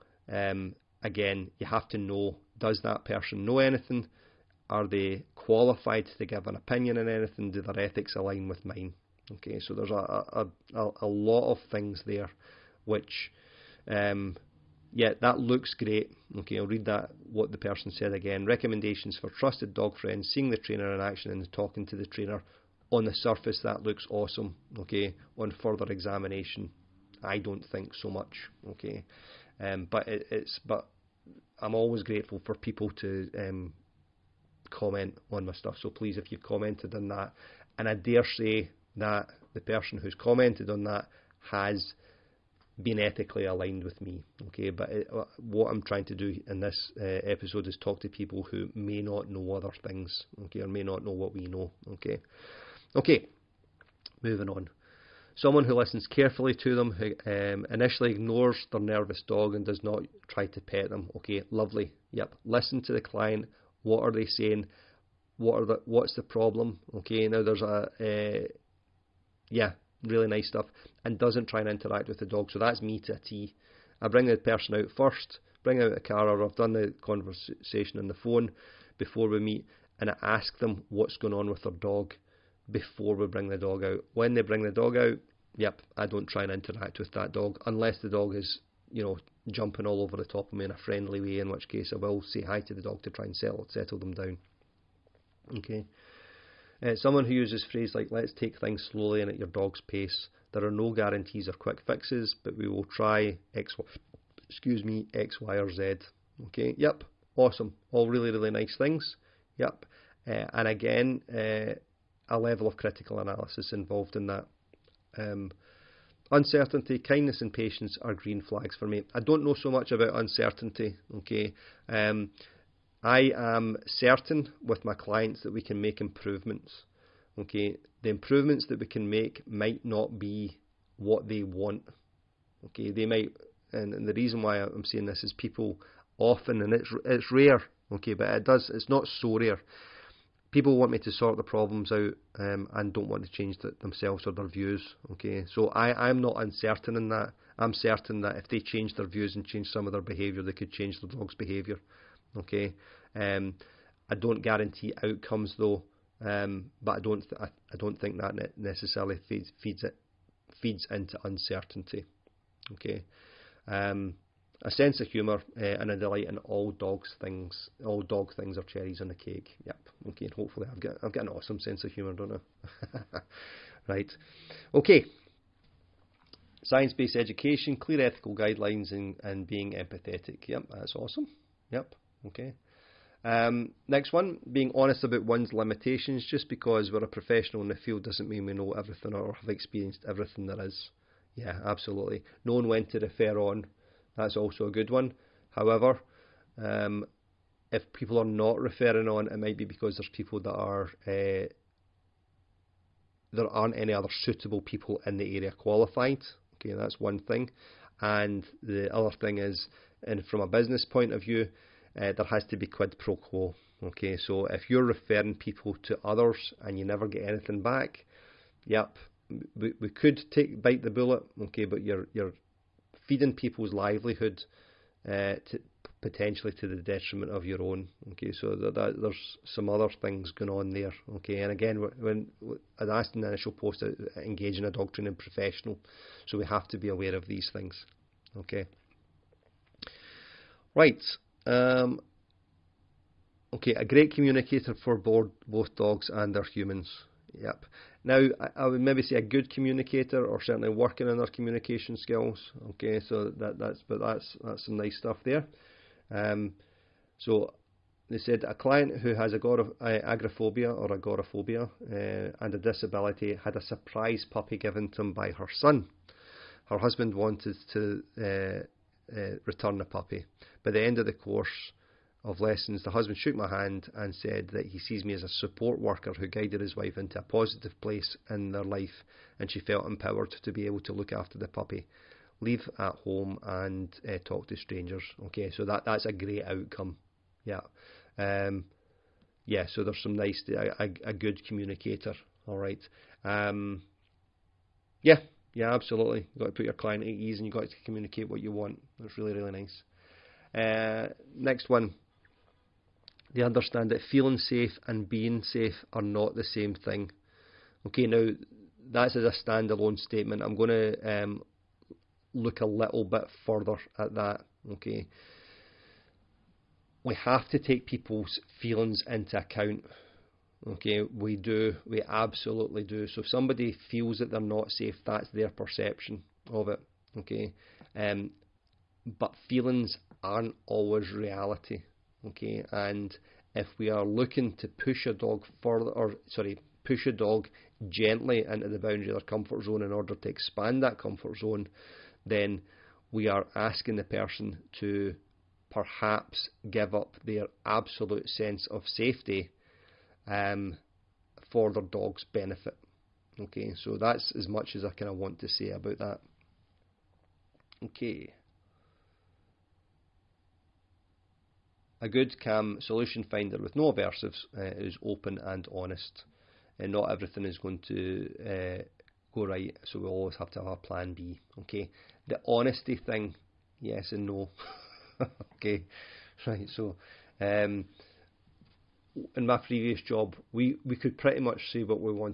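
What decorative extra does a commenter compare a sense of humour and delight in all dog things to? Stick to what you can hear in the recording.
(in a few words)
cherries on a cake.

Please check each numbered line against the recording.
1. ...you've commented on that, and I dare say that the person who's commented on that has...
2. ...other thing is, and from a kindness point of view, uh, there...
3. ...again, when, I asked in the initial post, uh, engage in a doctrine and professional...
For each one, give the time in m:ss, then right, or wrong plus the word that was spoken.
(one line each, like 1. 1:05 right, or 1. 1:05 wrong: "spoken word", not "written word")
1. 0:36 right
2. 3:28 wrong: "business", not "kindness"
3. 3:51 right.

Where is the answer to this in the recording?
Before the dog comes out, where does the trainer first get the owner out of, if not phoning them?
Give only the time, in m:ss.
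1:15.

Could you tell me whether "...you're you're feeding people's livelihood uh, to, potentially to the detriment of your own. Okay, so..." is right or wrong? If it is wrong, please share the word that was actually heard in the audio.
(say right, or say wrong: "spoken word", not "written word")
right.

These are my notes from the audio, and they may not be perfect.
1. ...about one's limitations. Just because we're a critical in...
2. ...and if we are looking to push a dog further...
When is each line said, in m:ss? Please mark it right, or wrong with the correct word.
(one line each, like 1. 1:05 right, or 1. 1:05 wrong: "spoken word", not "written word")
1. 3:05 wrong: "professional", not "critical"
2. 5:32 right.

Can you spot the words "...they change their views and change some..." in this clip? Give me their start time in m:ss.
2:28.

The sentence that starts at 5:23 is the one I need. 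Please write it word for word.
So if somebody feels that they're not safe, that's their perception of it.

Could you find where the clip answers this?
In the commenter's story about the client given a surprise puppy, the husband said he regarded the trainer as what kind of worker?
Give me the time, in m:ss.
4:35.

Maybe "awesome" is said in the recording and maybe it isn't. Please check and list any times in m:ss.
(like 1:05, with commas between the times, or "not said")
0:24, 1:47, 2:51, 3:00.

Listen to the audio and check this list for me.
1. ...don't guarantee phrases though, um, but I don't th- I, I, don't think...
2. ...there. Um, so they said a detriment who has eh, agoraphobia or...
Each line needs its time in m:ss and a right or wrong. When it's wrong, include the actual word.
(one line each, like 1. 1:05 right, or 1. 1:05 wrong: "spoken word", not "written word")
1. 2:34 wrong: "outcomes", not "phrases"
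2. 4:15 wrong: "client", not "detriment".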